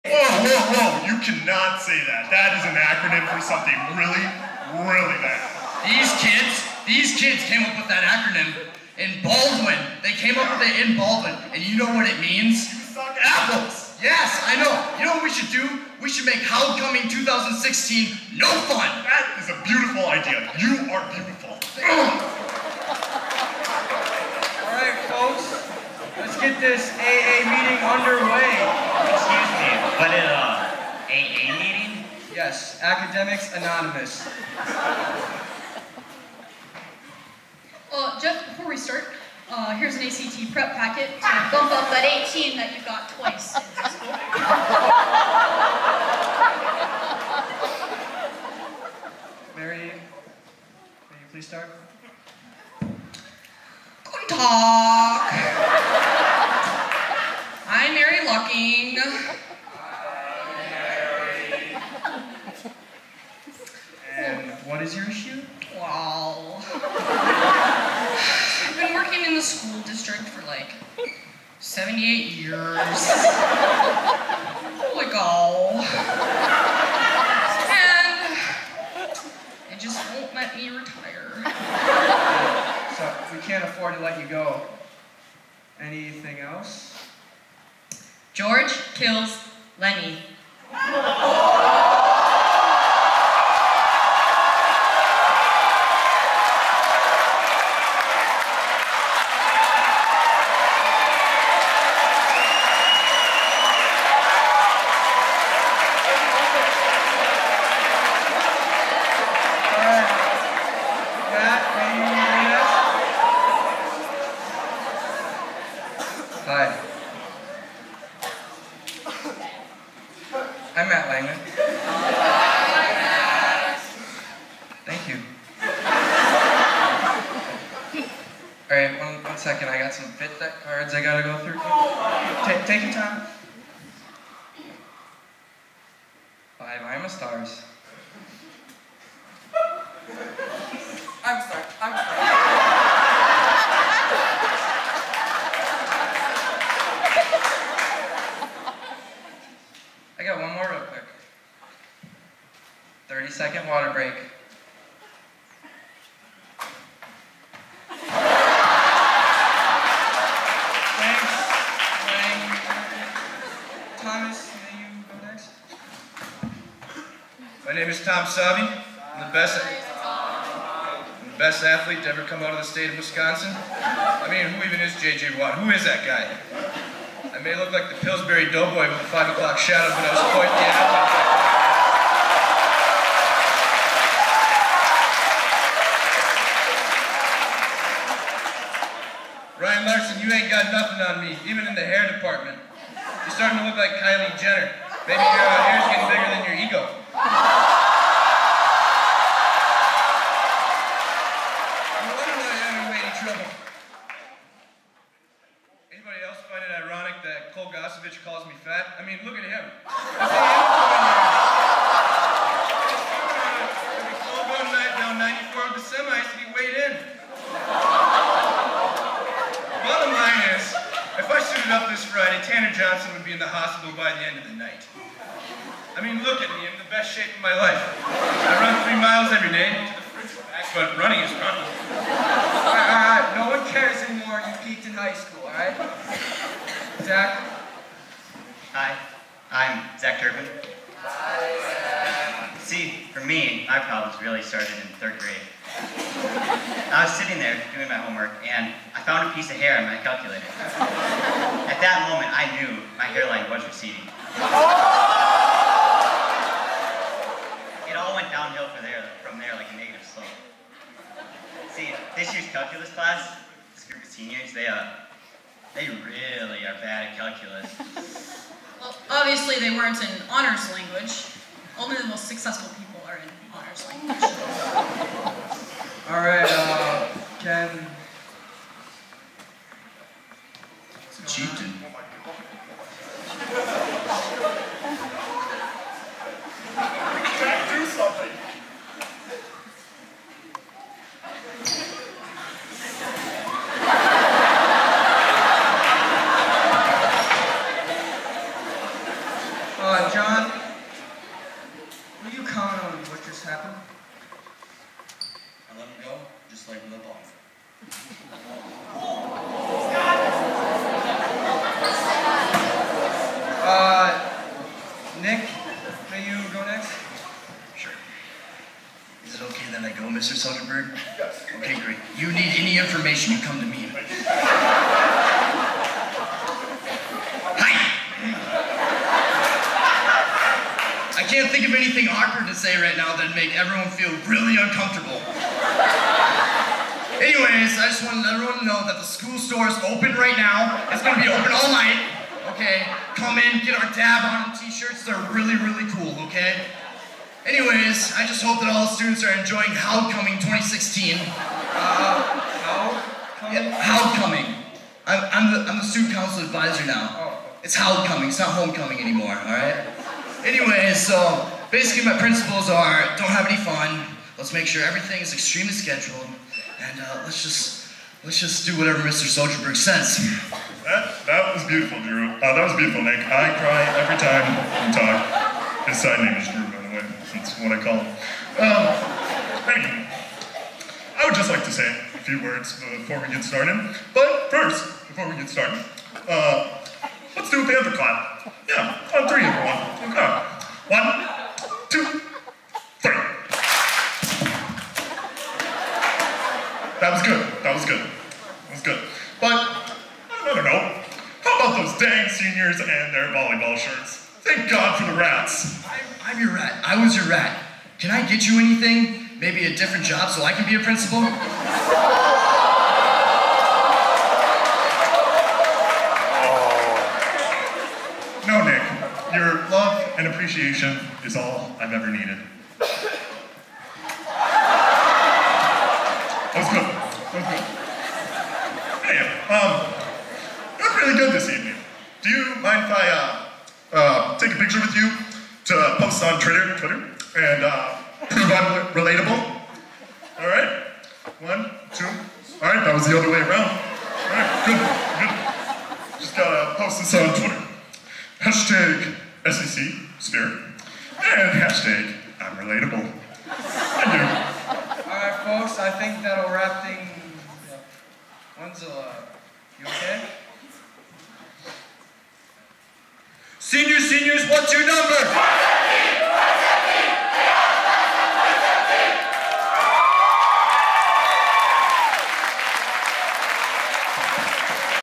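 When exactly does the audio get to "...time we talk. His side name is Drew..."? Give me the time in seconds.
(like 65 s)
374 s.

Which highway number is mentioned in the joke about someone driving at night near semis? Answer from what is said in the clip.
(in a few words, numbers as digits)
94.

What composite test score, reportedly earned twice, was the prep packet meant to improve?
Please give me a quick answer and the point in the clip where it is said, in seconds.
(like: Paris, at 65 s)
18, at 42 s.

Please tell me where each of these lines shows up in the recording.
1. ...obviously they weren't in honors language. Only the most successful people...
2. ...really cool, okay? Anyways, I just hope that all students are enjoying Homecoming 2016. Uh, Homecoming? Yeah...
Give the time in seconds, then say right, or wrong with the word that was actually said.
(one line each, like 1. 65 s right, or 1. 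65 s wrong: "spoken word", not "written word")
1. 269 s right
2. 345 s right.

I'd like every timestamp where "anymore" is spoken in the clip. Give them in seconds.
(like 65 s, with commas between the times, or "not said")
234 s, 358 s.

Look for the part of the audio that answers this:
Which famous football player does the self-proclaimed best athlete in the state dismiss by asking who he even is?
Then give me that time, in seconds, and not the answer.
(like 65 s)
175 s.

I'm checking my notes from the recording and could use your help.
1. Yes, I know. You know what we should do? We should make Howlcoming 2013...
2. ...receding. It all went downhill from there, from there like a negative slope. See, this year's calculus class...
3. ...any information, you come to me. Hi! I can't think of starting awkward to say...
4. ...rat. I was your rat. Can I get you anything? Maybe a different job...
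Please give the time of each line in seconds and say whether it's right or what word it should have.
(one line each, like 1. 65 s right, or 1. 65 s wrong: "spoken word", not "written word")
1. 14 s wrong: "2016", not "2013"
2. 253 s right
3. 322 s wrong: "anything", not "starting"
4. 406 s right.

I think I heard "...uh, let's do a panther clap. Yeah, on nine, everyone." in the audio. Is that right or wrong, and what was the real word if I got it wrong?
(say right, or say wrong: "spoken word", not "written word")
wrong: "three", not "nine".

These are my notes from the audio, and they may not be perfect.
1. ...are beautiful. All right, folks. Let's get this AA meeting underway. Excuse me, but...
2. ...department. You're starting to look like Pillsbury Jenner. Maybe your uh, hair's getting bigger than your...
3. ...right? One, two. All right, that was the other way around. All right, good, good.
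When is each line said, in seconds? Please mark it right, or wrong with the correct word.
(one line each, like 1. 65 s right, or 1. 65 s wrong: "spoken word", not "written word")
1. 20 s right
2. 192 s wrong: "Kylie", not "Pillsbury"
3. 440 s right.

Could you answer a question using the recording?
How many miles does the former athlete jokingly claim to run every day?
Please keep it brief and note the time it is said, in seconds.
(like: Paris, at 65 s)
3, at 228 s.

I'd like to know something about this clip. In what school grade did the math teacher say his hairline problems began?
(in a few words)
Third grade.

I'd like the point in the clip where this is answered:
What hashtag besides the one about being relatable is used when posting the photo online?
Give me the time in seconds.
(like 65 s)
449 s.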